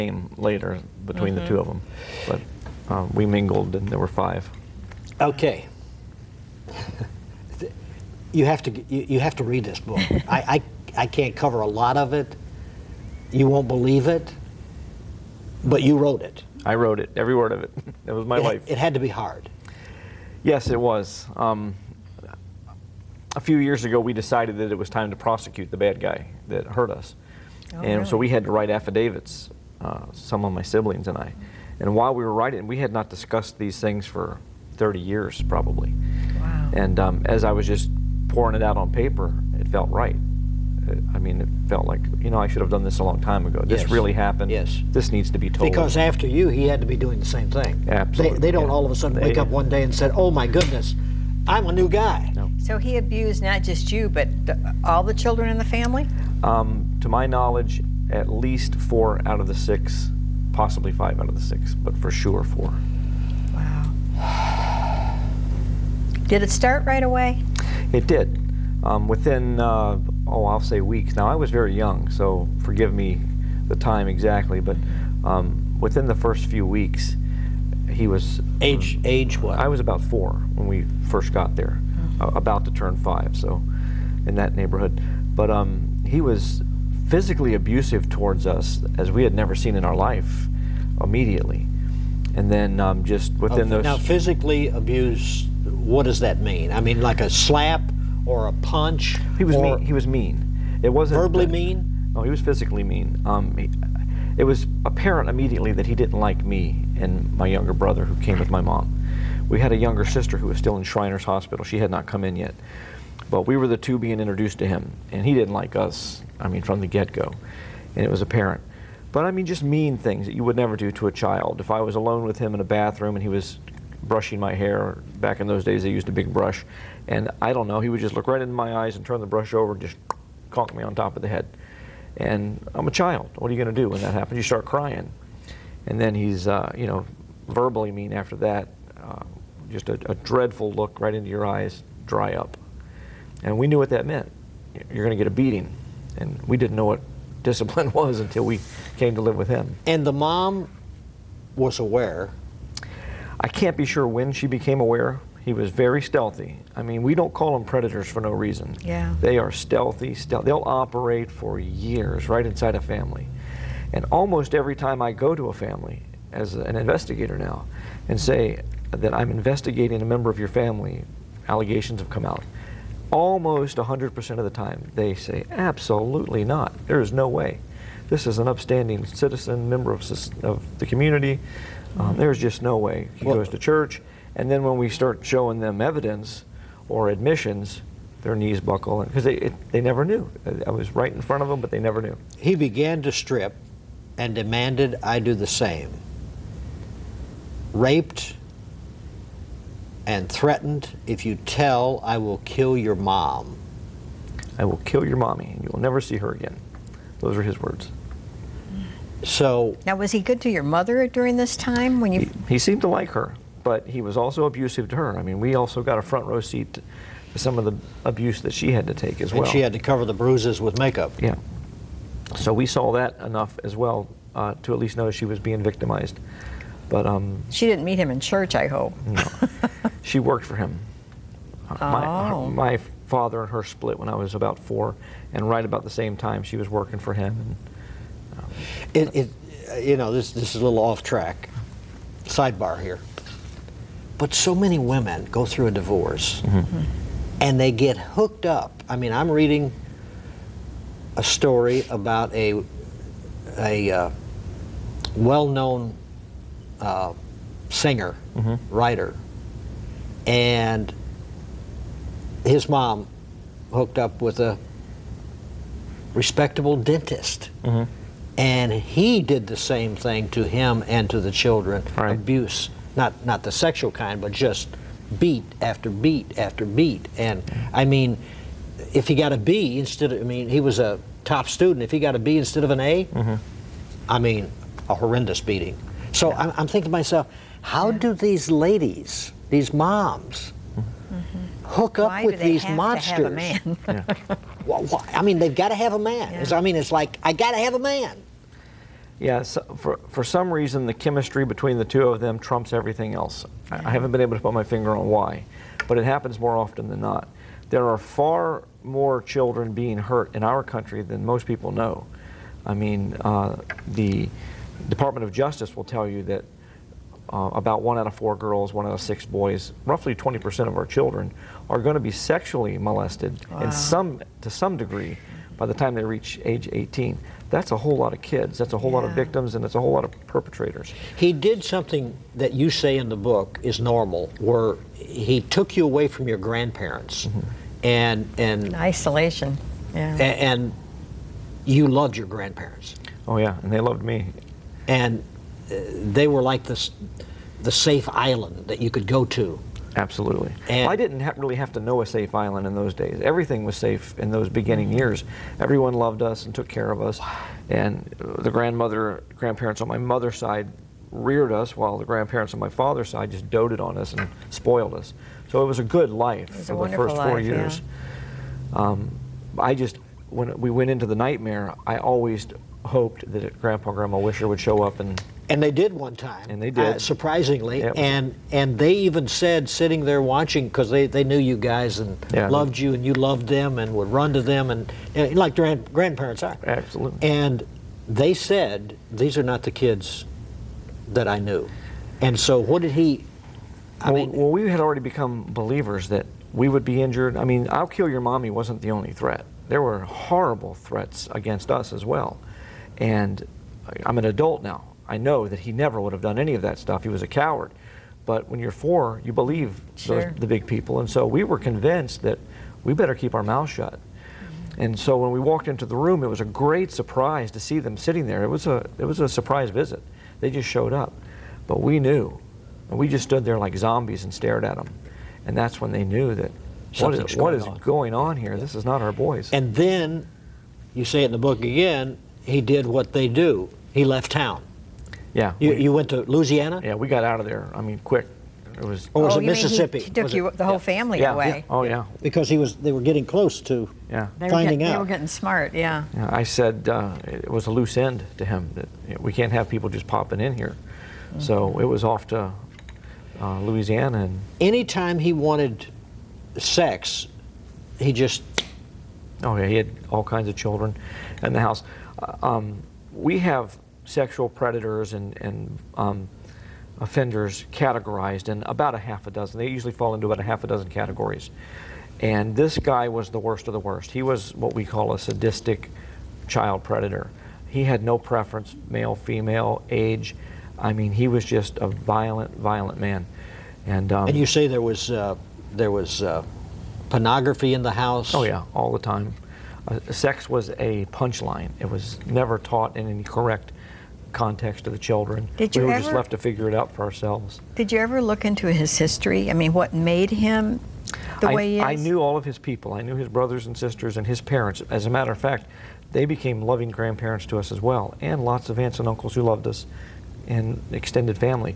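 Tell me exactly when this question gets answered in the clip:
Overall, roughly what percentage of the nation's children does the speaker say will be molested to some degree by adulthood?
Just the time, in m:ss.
5:20.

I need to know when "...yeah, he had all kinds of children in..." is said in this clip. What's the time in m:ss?
7:39.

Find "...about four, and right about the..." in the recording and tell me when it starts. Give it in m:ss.
3:54.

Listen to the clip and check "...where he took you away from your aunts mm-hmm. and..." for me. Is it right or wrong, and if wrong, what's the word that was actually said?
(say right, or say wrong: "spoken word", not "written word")
wrong: "grandparents", not "aunts".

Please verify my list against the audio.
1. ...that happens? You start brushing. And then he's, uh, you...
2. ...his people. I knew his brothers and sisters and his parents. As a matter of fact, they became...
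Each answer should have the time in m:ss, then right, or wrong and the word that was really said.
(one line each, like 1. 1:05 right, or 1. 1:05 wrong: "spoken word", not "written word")
1. 2:14 wrong: "crying", not "brushing"
2. 8:22 right.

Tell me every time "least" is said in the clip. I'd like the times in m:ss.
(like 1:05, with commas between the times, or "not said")
0:58, 3:44.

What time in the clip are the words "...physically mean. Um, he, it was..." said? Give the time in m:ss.
1:42.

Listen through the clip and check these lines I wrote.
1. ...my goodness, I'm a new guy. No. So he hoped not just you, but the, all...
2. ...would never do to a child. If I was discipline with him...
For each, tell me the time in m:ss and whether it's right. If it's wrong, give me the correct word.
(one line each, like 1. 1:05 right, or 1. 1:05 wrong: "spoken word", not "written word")
1. 0:50 wrong: "abused", not "hoped"
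2. 2:00 wrong: "alone", not "discipline".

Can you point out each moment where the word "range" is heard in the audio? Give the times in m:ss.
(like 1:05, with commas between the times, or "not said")
not said.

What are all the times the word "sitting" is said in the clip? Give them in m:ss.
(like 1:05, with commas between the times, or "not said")
6:19, 6:57.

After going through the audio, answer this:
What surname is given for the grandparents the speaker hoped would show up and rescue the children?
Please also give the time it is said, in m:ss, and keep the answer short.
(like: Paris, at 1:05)
Wischer, at 6:14.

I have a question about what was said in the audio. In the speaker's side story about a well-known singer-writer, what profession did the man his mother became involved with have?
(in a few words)
dentist.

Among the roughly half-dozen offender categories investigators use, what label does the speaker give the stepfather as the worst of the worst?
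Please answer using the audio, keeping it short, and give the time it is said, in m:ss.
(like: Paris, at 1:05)
sadistic child predator, at 7:55.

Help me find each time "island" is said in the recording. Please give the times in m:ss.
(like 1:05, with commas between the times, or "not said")
5:48, 5:52.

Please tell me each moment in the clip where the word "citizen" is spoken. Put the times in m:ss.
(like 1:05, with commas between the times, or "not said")
2:59.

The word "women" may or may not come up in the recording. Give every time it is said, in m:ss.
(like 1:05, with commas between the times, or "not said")
4:04.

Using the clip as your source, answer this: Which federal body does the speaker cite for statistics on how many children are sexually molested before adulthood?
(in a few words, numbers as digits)
Department of Justice.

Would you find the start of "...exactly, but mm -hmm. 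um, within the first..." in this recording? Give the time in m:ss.
1:14.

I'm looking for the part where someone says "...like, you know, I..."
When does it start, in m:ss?
0:41.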